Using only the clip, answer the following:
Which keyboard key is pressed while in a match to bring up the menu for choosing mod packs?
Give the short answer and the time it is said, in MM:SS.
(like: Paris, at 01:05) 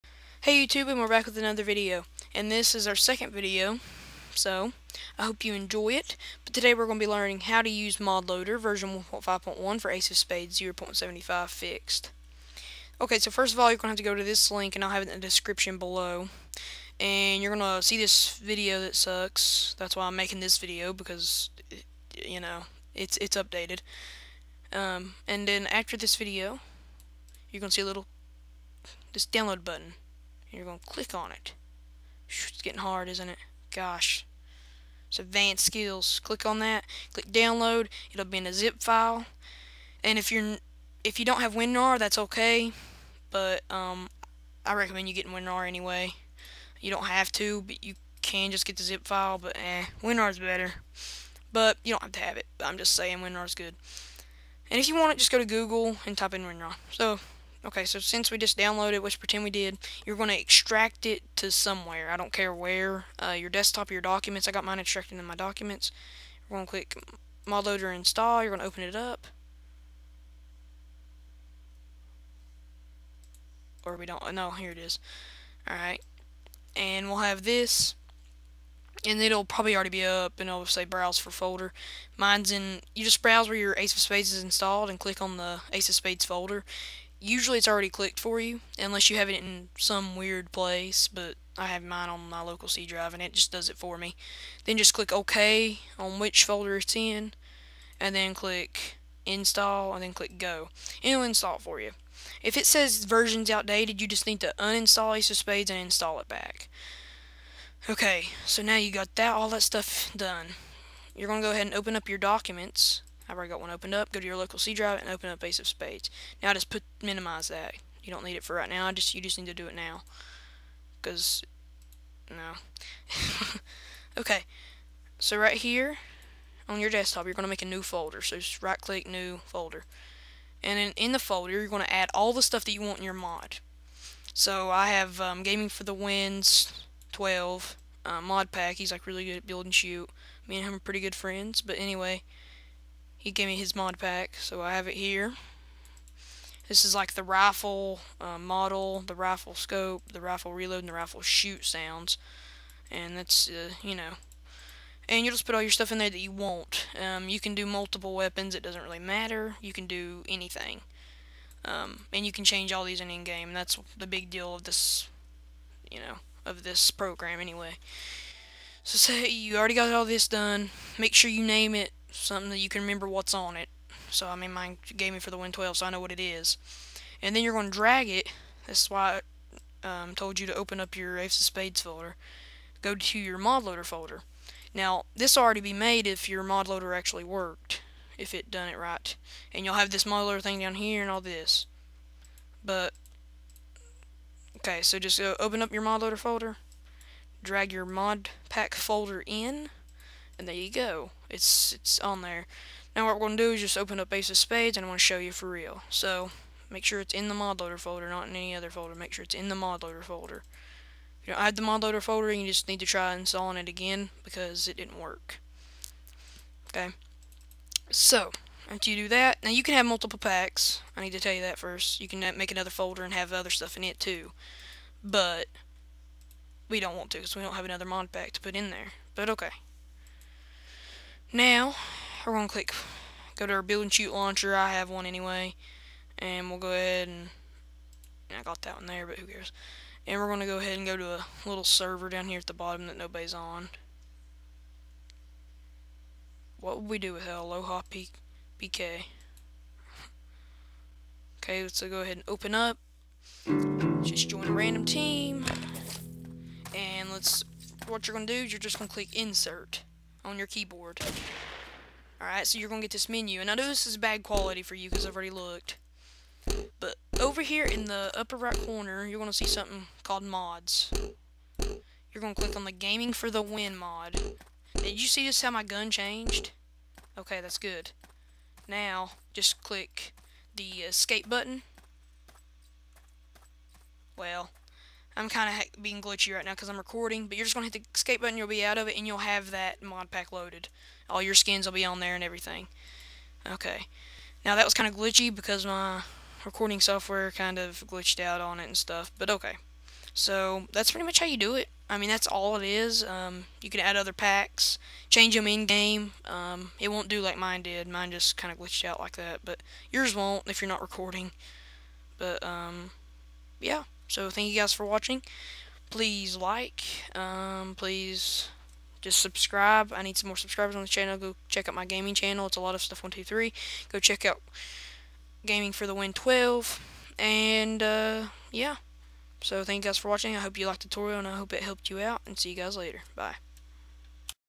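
Insert, at 04:19.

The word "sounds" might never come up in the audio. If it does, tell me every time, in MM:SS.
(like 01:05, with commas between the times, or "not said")
02:31.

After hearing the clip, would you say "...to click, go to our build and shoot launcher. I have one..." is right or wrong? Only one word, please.
right.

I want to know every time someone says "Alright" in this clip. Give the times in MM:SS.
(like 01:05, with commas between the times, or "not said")
01:15, 04:22.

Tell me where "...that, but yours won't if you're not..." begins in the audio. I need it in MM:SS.
05:09.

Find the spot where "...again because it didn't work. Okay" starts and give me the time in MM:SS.
03:33.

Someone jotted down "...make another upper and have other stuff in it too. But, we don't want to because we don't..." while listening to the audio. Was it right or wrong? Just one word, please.
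wrong.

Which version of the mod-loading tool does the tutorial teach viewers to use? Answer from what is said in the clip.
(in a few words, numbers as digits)
1.5.1.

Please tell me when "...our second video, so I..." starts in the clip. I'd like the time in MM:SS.
00:02.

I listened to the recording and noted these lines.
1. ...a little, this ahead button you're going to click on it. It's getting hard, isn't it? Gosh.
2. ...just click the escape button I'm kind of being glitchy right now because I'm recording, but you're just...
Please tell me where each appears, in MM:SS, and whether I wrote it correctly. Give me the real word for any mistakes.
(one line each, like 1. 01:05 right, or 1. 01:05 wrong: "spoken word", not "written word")
1. 00:27 wrong: "download", not "ahead"
2. 04:39 right.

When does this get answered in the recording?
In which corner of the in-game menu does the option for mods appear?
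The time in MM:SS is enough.
04:28.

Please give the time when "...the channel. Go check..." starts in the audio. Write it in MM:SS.
05:20.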